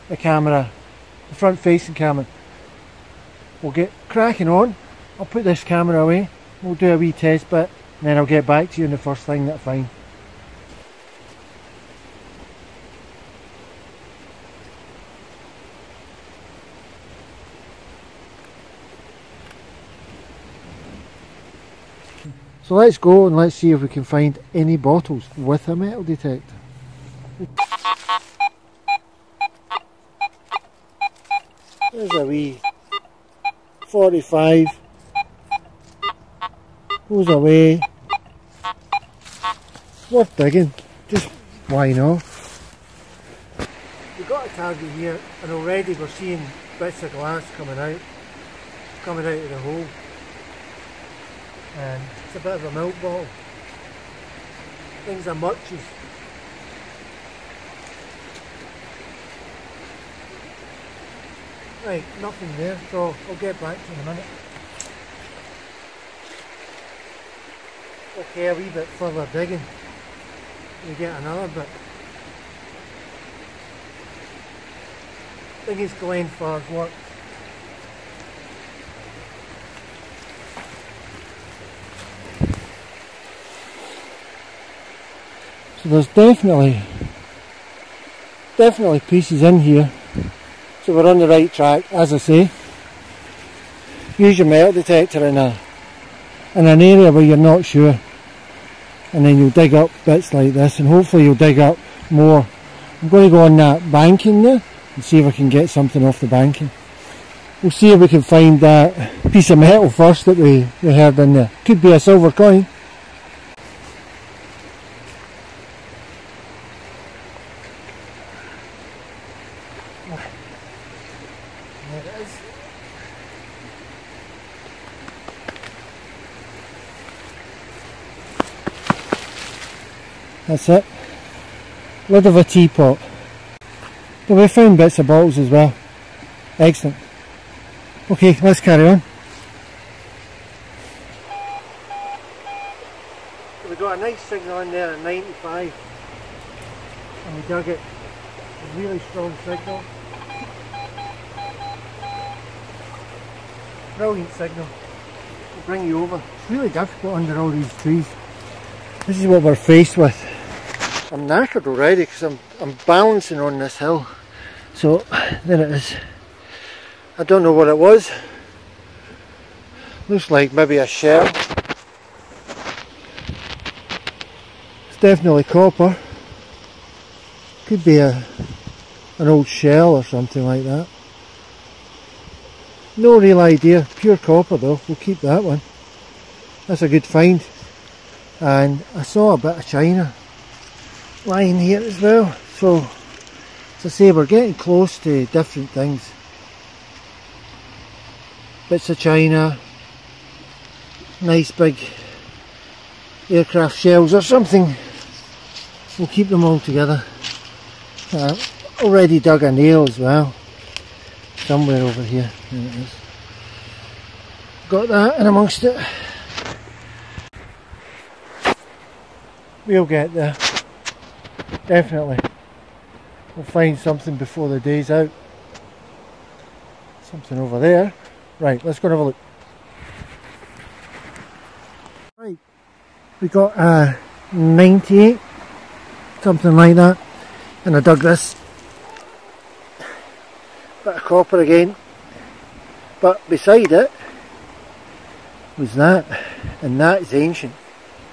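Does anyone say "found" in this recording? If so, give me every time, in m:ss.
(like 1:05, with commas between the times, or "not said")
2:14.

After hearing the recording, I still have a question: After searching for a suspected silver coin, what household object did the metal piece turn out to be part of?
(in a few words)
lid of a teapot.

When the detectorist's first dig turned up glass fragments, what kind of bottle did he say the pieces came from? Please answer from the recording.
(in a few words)
milk bottle.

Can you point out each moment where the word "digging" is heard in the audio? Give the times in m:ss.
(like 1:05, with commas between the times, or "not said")
0:40, 1:09.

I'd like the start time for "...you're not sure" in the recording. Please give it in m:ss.
1:37.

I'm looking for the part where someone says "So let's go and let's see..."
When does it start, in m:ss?
0:22.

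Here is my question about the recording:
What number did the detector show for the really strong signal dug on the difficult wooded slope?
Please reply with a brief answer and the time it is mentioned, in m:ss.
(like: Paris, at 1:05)
95, at 2:25.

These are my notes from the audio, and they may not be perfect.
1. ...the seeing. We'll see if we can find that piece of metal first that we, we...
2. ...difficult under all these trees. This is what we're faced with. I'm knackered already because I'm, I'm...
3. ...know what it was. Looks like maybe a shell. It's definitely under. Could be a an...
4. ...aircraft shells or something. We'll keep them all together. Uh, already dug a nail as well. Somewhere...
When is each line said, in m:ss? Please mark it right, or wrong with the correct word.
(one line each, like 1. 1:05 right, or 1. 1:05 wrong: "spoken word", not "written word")
1. 1:46 wrong: "banking", not "seeing"
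2. 2:36 right
3. 2:47 wrong: "copper", not "under"
4. 3:23 right.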